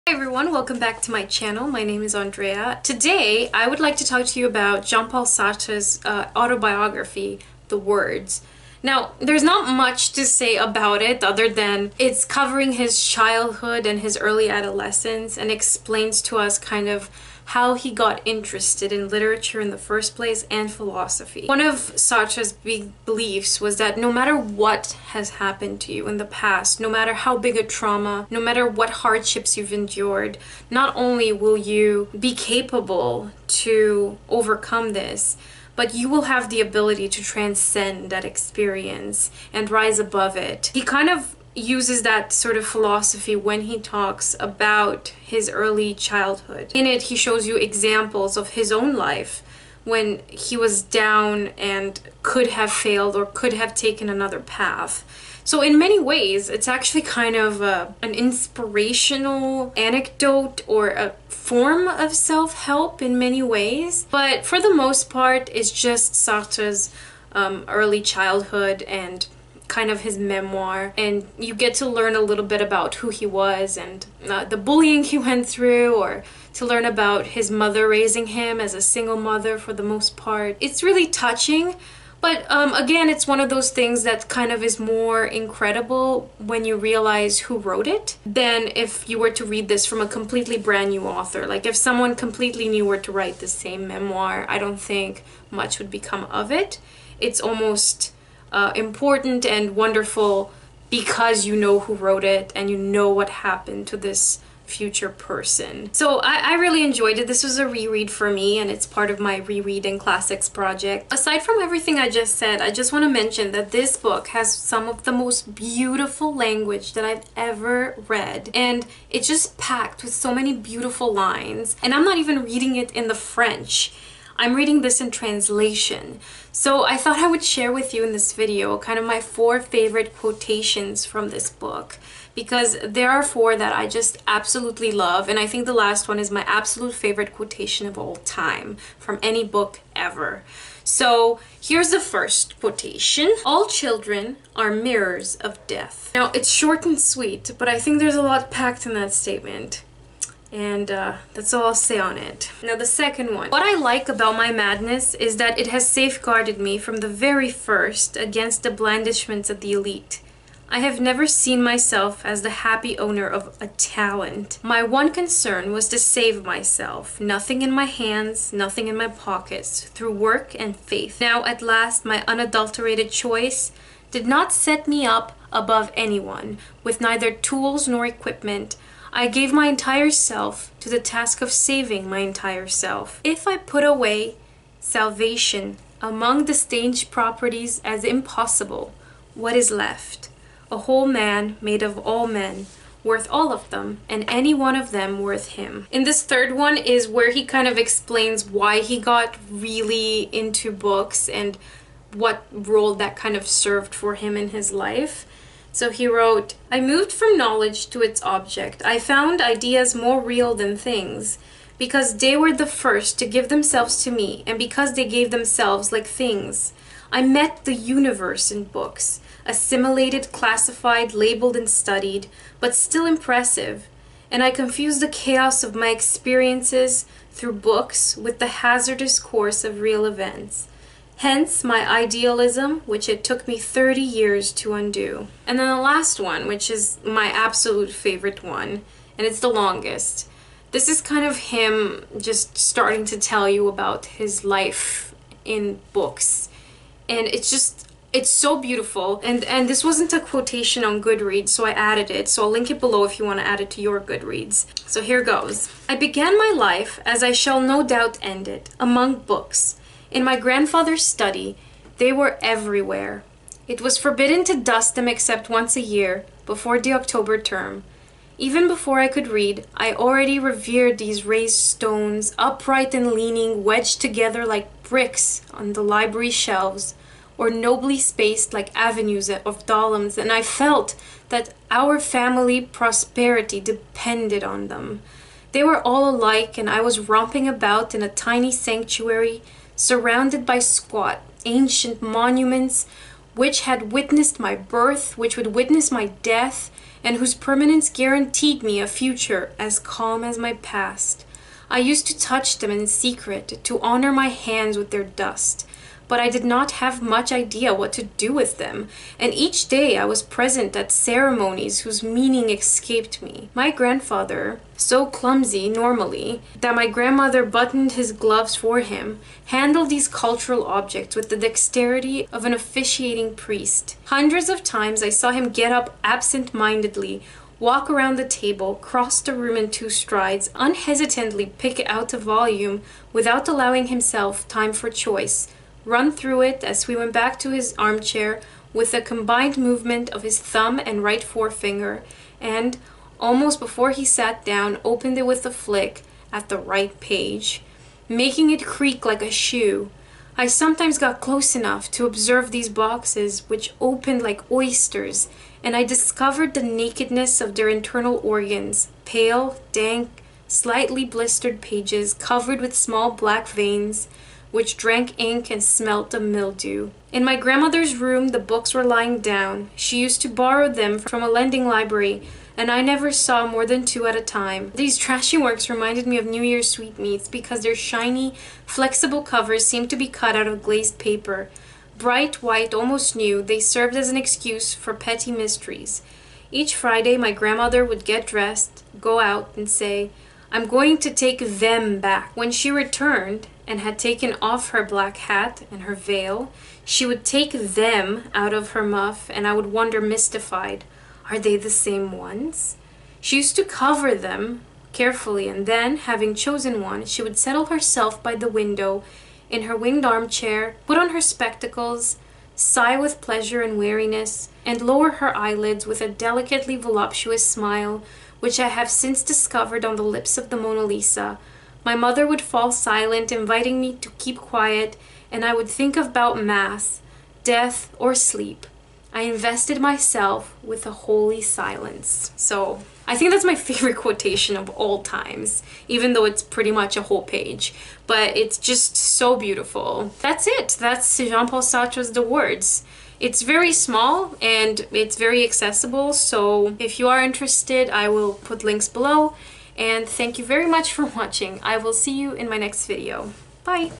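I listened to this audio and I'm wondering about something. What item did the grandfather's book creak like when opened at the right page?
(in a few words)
a shoe.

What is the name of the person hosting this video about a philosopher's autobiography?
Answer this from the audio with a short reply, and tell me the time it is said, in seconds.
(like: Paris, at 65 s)
Andreea, at 2 s.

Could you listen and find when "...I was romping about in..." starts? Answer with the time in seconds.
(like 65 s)
286 s.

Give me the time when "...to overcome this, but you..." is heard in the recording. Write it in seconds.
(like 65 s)
33 s.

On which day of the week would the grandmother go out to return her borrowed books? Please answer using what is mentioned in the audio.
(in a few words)
Friday.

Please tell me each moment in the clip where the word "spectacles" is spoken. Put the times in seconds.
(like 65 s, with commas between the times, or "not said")
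411 s.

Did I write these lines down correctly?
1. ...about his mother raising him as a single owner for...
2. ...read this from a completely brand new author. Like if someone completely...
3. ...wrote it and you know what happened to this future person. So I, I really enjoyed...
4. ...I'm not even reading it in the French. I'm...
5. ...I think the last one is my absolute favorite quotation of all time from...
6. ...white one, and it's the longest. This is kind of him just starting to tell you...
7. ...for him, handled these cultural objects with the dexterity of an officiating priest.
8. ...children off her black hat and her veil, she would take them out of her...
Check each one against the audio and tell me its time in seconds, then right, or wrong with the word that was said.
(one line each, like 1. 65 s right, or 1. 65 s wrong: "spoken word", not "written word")
1. 76 s wrong: "mother", not "owner"
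2. 89 s right
3. 101 s right
4. 121 s right
5. 135 s right
6. 237 s wrong: "favorite", not "white"
7. 318 s right
8. 393 s wrong: "taken", not "children".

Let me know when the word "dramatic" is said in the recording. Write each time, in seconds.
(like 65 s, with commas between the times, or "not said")
not said.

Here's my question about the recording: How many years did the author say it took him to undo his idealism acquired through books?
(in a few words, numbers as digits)
30.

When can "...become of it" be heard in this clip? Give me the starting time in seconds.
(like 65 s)
95 s.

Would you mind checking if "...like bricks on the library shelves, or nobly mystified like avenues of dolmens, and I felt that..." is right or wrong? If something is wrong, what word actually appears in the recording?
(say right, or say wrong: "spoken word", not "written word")
wrong: "spaced", not "mystified".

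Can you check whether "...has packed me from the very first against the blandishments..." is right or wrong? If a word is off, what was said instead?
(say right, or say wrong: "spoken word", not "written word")
wrong: "safeguarded", not "packed".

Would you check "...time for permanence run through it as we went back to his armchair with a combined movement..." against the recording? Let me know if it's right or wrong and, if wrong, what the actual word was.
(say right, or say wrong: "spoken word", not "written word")
wrong: "choice", not "permanence".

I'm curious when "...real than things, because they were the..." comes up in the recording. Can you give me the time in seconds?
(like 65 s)
210 s.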